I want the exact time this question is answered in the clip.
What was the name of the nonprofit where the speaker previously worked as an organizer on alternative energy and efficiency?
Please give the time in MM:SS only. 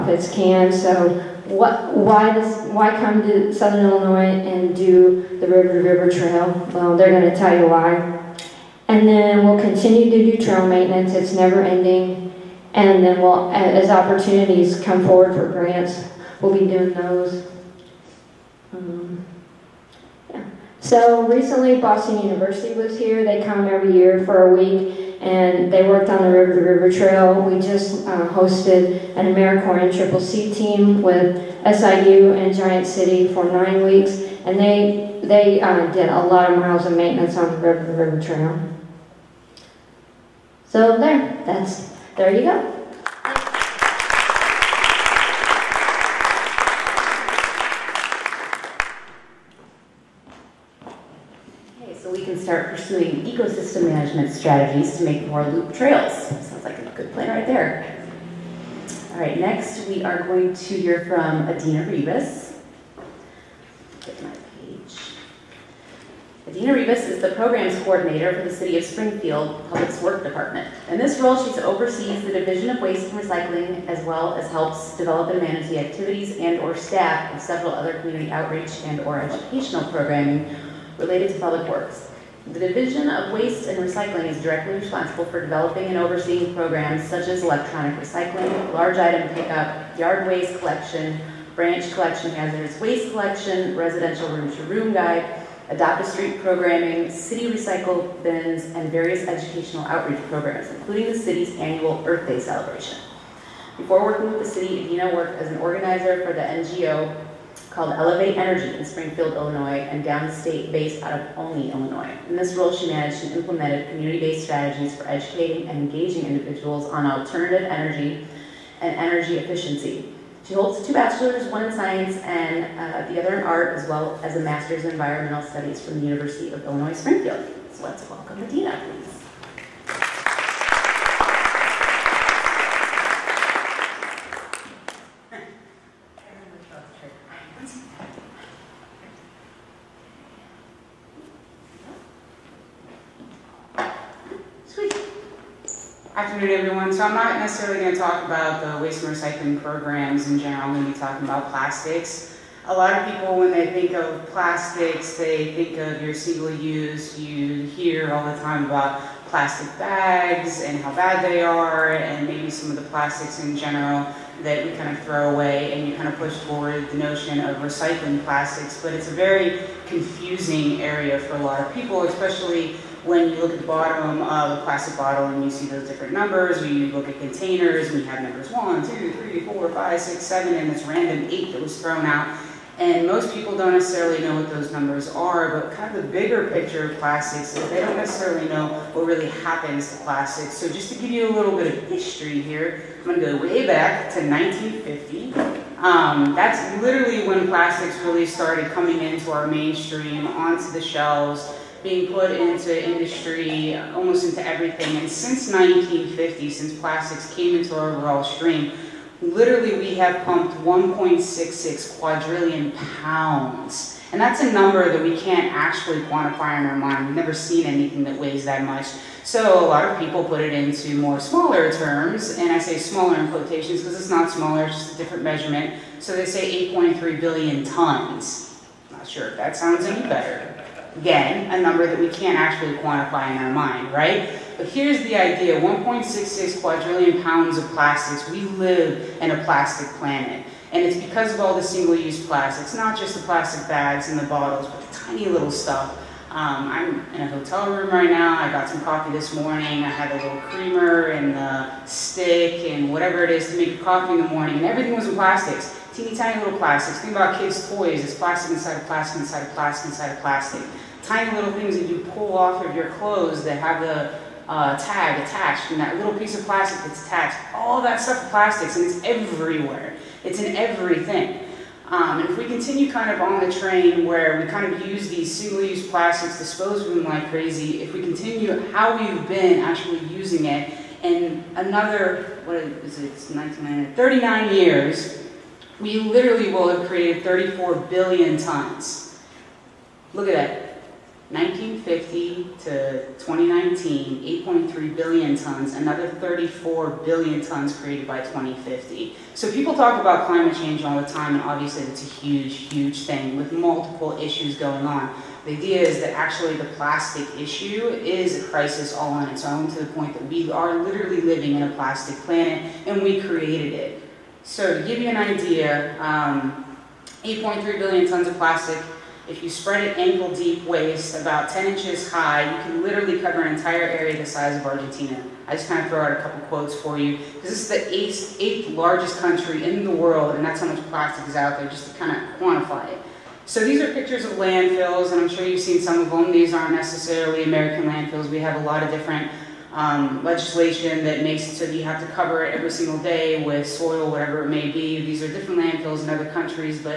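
01:47.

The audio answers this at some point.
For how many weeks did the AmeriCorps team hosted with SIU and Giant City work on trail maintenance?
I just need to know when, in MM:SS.
00:33.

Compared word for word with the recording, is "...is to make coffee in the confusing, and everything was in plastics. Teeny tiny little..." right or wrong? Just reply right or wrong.
wrong.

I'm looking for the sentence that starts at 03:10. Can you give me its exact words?
So just to give you a little bit of history here, I'm gonna go way back to 1950.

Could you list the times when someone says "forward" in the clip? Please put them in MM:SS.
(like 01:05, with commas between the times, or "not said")
00:15, 02:46.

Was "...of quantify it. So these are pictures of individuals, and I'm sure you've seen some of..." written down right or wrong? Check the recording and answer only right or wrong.
wrong.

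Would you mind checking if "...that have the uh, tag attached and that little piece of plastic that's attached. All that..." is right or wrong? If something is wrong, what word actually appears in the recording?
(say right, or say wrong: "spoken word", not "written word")
right.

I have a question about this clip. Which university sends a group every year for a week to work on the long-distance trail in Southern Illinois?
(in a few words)
Boston University.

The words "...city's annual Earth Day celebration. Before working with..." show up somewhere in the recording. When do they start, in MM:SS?
01:41.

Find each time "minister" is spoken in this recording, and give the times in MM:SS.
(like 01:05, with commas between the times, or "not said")
not said.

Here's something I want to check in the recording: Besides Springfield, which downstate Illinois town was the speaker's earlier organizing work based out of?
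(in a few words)
Olney.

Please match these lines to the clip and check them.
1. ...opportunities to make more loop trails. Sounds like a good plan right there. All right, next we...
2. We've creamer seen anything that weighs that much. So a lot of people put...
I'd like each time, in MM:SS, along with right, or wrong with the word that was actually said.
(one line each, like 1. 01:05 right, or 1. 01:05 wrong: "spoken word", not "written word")
1. 00:54 wrong: "strategies", not "opportunities"
2. 03:37 wrong: "never", not "creamer".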